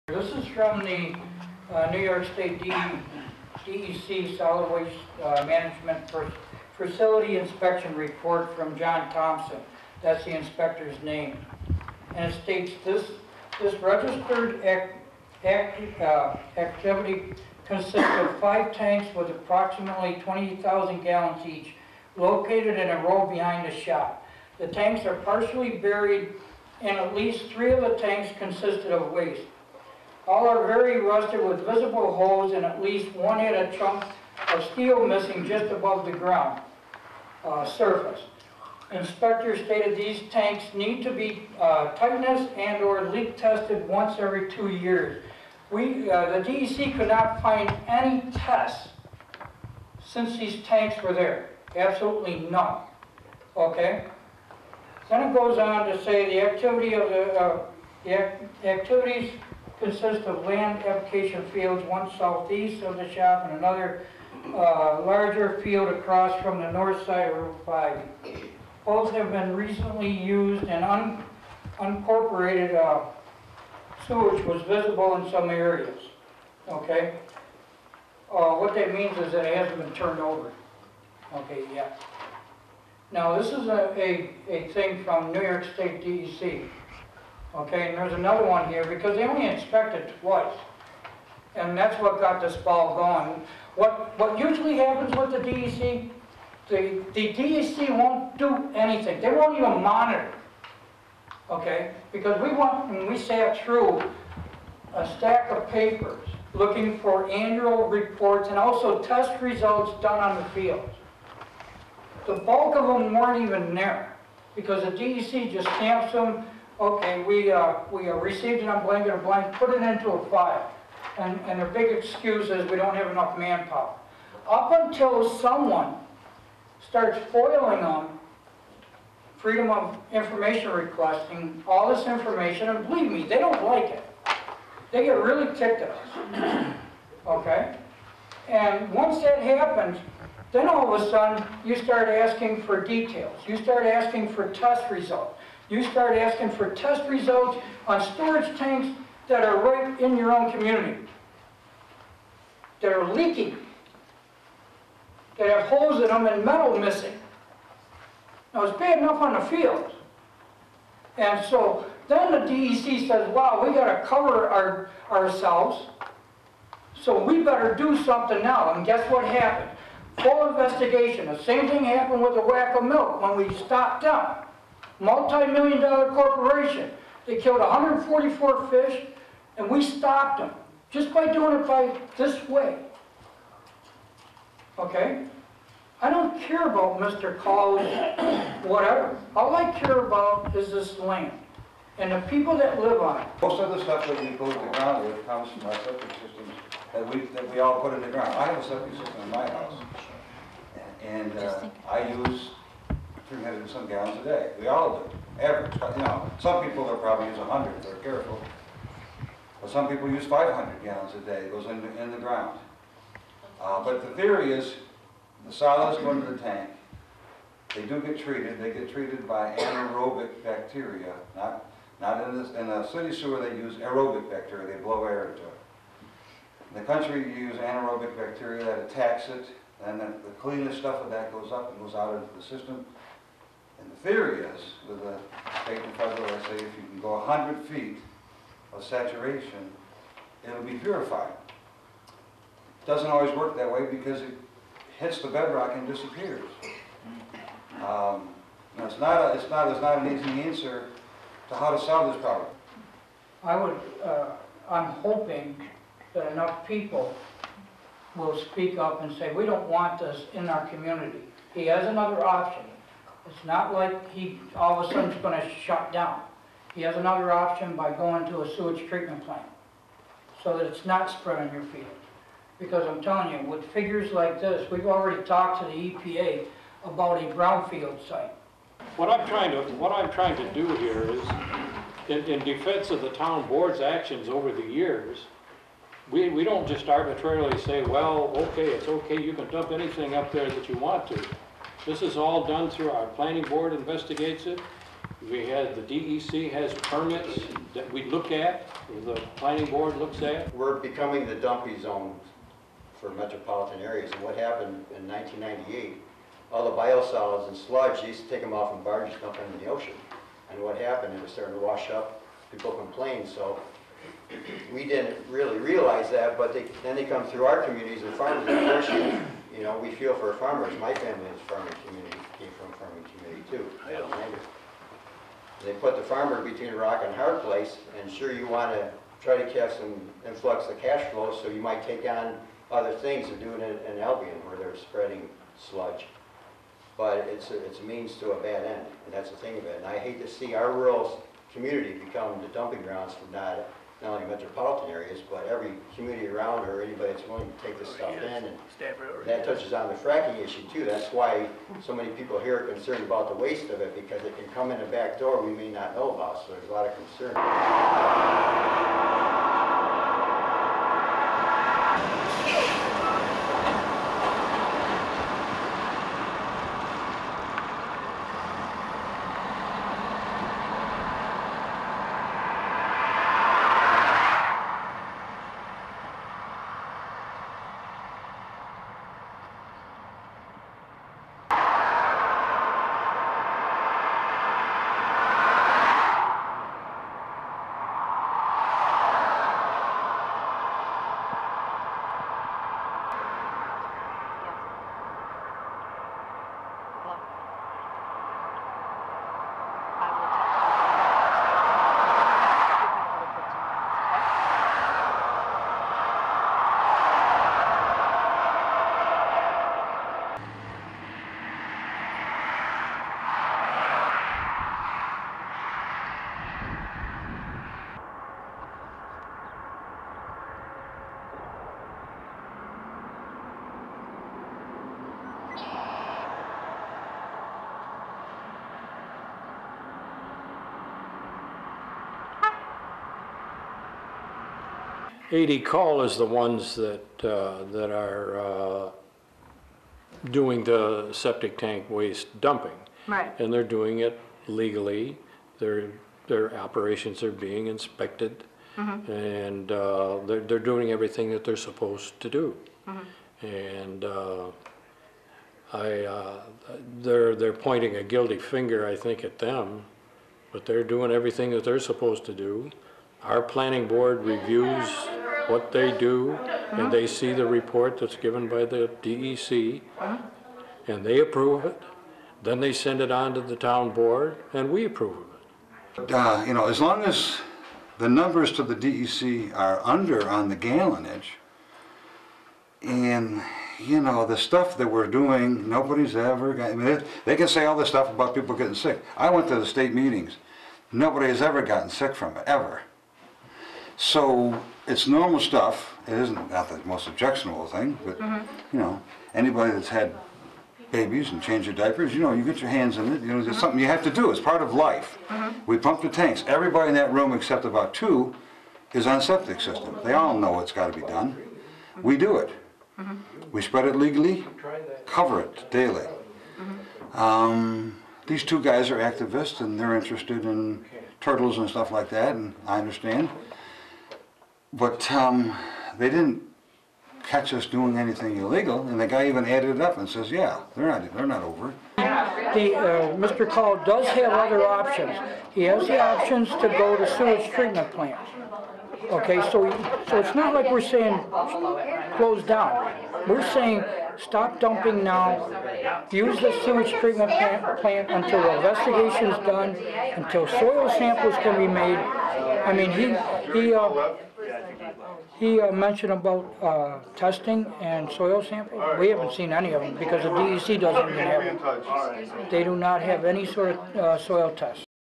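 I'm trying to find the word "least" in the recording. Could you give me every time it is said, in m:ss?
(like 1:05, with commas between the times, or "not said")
0:27, 0:32.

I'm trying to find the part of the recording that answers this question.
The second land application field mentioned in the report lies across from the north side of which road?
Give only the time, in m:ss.
1:07.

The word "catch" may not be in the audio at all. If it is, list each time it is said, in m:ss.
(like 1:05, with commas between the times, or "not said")
5:29, 8:47.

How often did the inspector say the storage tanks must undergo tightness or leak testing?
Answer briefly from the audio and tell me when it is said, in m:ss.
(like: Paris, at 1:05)
Once every two years, at 0:43.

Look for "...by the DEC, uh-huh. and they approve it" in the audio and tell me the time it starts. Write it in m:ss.
7:48.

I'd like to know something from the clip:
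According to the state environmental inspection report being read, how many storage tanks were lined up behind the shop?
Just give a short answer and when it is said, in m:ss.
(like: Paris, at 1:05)
5, at 0:18.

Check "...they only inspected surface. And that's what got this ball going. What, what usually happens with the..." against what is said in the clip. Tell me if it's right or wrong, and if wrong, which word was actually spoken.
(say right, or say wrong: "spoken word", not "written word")
wrong: "twice", not "surface".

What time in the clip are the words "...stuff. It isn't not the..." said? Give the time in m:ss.
8:15.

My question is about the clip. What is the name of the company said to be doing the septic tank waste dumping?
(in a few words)
A.D. Call.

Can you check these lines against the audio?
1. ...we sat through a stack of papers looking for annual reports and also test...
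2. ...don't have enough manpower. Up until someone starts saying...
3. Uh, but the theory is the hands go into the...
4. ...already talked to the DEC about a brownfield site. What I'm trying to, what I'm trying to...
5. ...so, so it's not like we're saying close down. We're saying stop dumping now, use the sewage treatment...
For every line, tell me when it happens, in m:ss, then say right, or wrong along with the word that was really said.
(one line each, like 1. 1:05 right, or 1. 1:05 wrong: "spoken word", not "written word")
1. 1:43 right
2. 2:02 wrong: "foiling", not "saying"
3. 3:33 wrong: "solids", not "hands"
4. 4:34 wrong: "EPA", not "DEC"
5. 8:59 right.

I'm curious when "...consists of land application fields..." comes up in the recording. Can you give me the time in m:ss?
0:59.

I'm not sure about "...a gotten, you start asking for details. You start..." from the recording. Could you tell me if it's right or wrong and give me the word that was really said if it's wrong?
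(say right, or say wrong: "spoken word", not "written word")
wrong: "sudden", not "gotten".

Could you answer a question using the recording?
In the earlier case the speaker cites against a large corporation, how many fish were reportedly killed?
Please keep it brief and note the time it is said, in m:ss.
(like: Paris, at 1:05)
144, at 2:57.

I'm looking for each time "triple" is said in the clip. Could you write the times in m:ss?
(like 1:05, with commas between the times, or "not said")
not said.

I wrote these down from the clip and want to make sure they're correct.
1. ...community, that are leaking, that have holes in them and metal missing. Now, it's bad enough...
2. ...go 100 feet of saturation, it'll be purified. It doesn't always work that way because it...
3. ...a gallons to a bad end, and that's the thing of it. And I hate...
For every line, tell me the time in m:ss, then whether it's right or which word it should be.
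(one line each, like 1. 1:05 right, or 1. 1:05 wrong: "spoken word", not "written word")
1. 2:30 right
2. 3:57 right
3. 5:37 wrong: "means", not "gallons".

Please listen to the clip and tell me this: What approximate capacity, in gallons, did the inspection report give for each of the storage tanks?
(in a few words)
20,000 gallons.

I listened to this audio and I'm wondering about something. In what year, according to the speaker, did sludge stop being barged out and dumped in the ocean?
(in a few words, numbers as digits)
1998.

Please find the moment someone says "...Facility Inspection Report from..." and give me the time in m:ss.
0:06.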